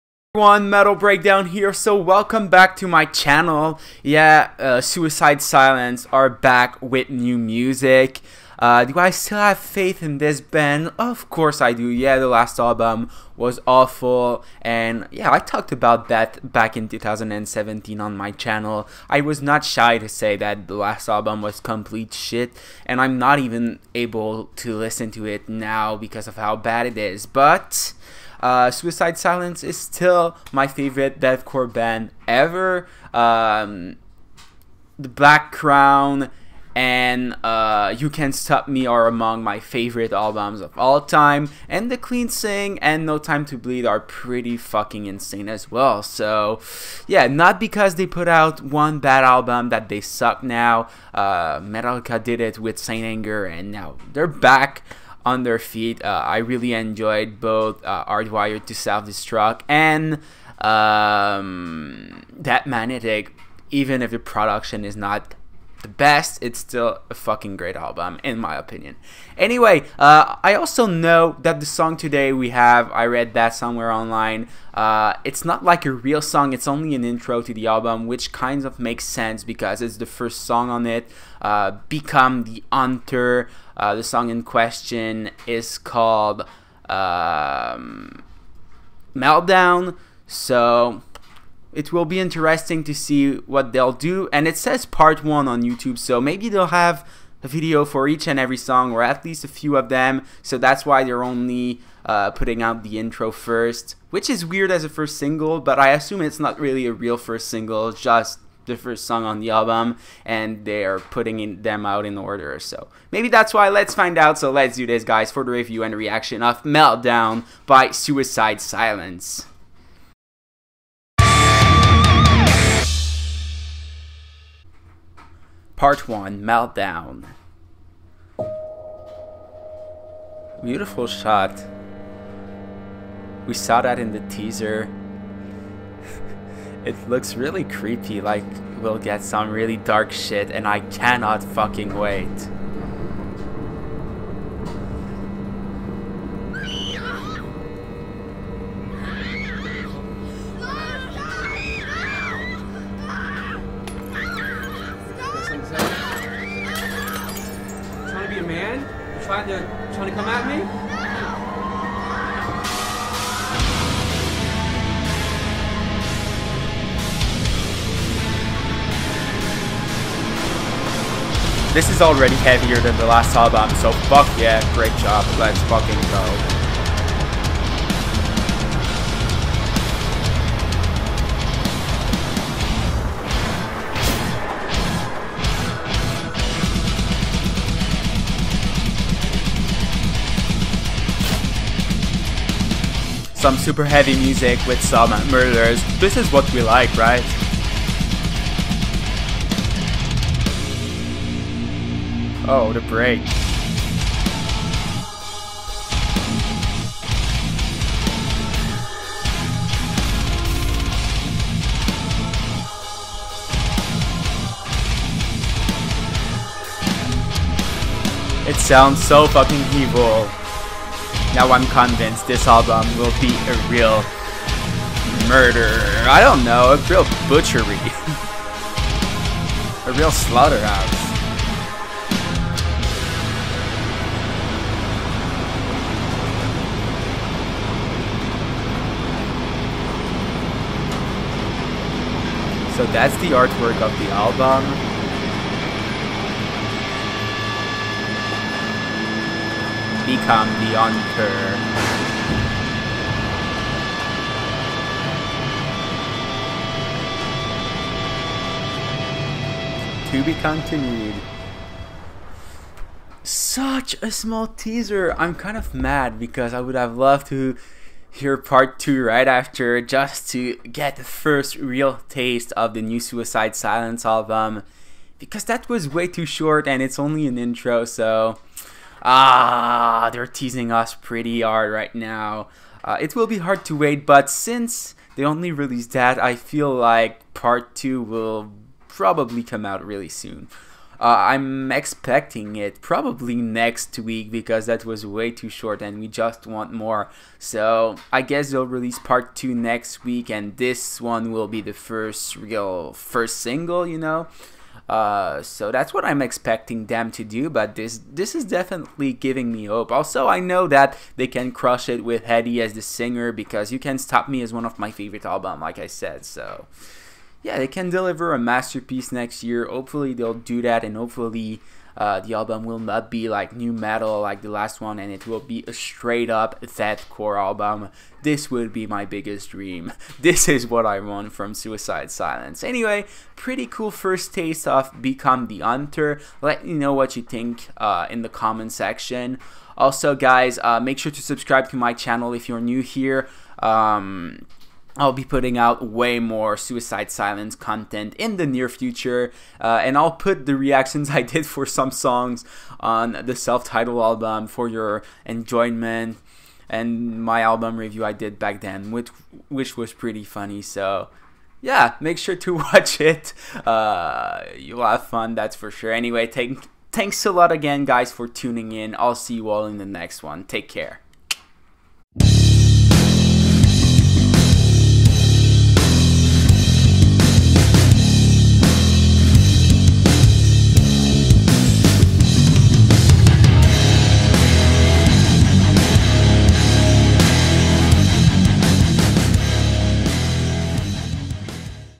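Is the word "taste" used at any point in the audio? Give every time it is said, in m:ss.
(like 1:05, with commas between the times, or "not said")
4:32, 5:34.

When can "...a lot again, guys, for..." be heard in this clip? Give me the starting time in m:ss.
6:07.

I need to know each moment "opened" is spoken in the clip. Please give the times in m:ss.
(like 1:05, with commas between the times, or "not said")
not said.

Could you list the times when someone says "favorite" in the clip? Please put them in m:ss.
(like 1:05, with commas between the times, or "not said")
0:30, 0:39, 5:14.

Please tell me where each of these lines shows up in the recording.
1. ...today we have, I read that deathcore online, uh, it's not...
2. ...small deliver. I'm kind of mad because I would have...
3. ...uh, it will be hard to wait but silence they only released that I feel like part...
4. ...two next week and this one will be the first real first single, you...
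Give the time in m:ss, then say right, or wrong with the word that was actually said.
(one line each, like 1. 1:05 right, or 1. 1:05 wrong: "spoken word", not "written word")
1. 1:11 wrong: "somewhere", not "deathcore"
2. 4:24 wrong: "teaser", not "deliver"
3. 4:42 wrong: "since", not "silence"
4. 4:59 right.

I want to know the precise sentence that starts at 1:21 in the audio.
Uh, Become the Hunter uh, the song in question is called um, Meltdown.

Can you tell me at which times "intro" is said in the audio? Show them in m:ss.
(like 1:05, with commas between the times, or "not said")
1:17, 1:42, 4:37.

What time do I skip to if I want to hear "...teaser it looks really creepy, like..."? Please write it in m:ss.
2:14.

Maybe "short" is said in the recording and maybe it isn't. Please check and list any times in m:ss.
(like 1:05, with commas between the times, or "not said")
4:36, 4:55.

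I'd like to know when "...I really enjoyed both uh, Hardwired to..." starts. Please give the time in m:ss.
0:56.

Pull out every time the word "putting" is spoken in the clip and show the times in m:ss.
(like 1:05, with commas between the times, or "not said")
1:42, 1:50, 5:45.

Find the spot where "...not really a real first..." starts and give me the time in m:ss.
1:46.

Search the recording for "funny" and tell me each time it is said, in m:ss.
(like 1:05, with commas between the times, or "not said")
6:00.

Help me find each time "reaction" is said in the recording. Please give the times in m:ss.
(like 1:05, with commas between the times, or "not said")
1:55, 5:50.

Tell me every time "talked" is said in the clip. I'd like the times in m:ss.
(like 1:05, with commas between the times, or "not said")
0:15.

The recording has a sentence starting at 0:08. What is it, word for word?
Uh, do I still have faith in this band?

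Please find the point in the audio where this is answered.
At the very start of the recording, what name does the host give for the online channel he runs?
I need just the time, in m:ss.
0:00.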